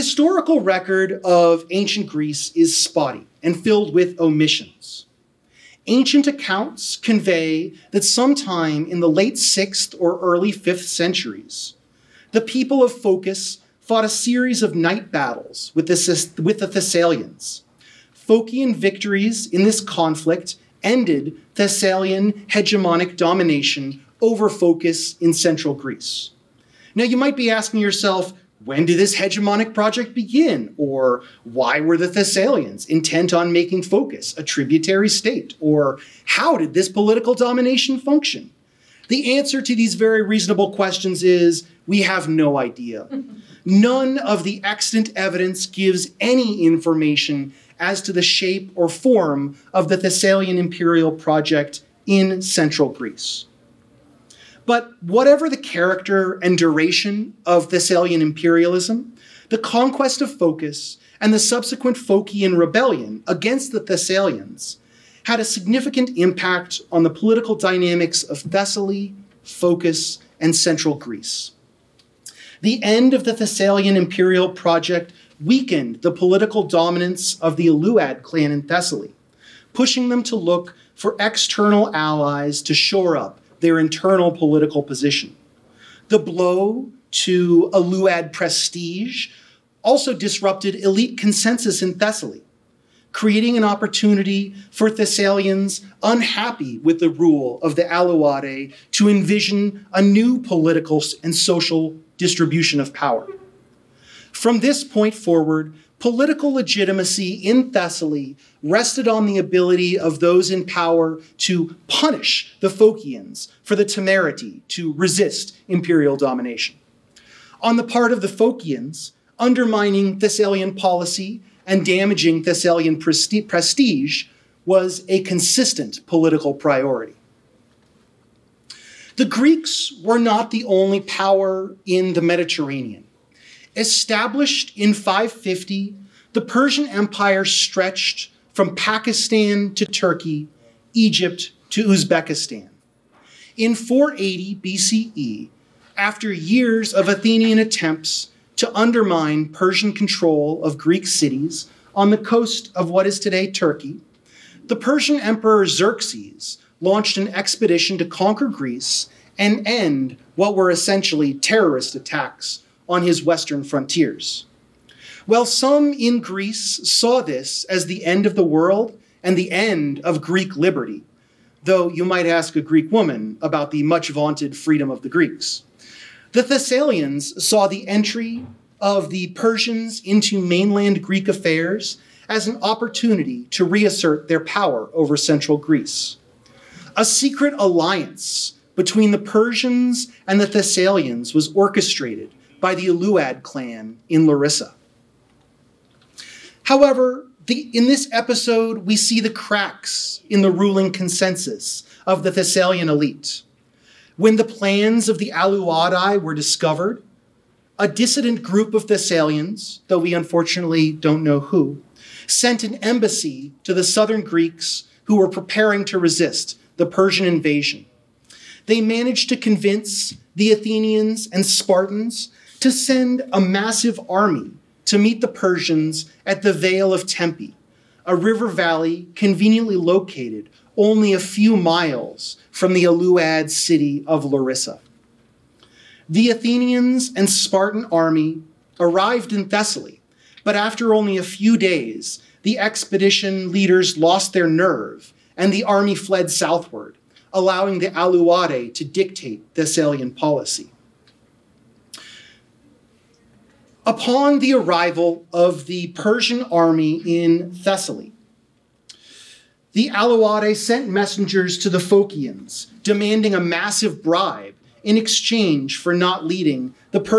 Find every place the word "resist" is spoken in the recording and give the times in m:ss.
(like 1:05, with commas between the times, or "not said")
1:54, 3:35.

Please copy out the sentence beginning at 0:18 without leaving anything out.
Phocian victories in this conflict ended Thessalian hegemonic domination over Phocis in central Greece.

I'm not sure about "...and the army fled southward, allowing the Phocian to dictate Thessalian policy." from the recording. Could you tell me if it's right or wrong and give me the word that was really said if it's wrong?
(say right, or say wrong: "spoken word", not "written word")
wrong: "Aleuadae", not "Phocian".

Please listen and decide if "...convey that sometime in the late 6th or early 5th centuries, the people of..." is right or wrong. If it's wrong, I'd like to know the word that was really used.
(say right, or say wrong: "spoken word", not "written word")
right.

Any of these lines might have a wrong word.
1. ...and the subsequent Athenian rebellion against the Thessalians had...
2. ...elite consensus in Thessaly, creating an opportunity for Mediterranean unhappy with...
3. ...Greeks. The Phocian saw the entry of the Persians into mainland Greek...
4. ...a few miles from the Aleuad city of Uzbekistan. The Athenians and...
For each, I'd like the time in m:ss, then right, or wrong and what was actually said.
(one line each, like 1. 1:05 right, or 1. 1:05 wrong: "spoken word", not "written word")
1. 1:01 wrong: "Phocian", not "Athenian"
2. 1:30 wrong: "Thessalians", not "Mediterranean"
3. 2:55 wrong: "Thessalians", not "Phocian"
4. 3:51 wrong: "Larissa", not "Uzbekistan".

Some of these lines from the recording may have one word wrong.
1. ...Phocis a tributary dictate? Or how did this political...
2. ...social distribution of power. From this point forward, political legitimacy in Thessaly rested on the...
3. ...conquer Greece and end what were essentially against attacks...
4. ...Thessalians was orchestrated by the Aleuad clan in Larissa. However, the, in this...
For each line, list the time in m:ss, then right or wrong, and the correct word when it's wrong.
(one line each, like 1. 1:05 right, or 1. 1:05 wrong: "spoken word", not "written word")
1. 0:33 wrong: "state", not "dictate"
2. 1:41 right
3. 2:38 wrong: "terrorist", not "against"
4. 3:10 right.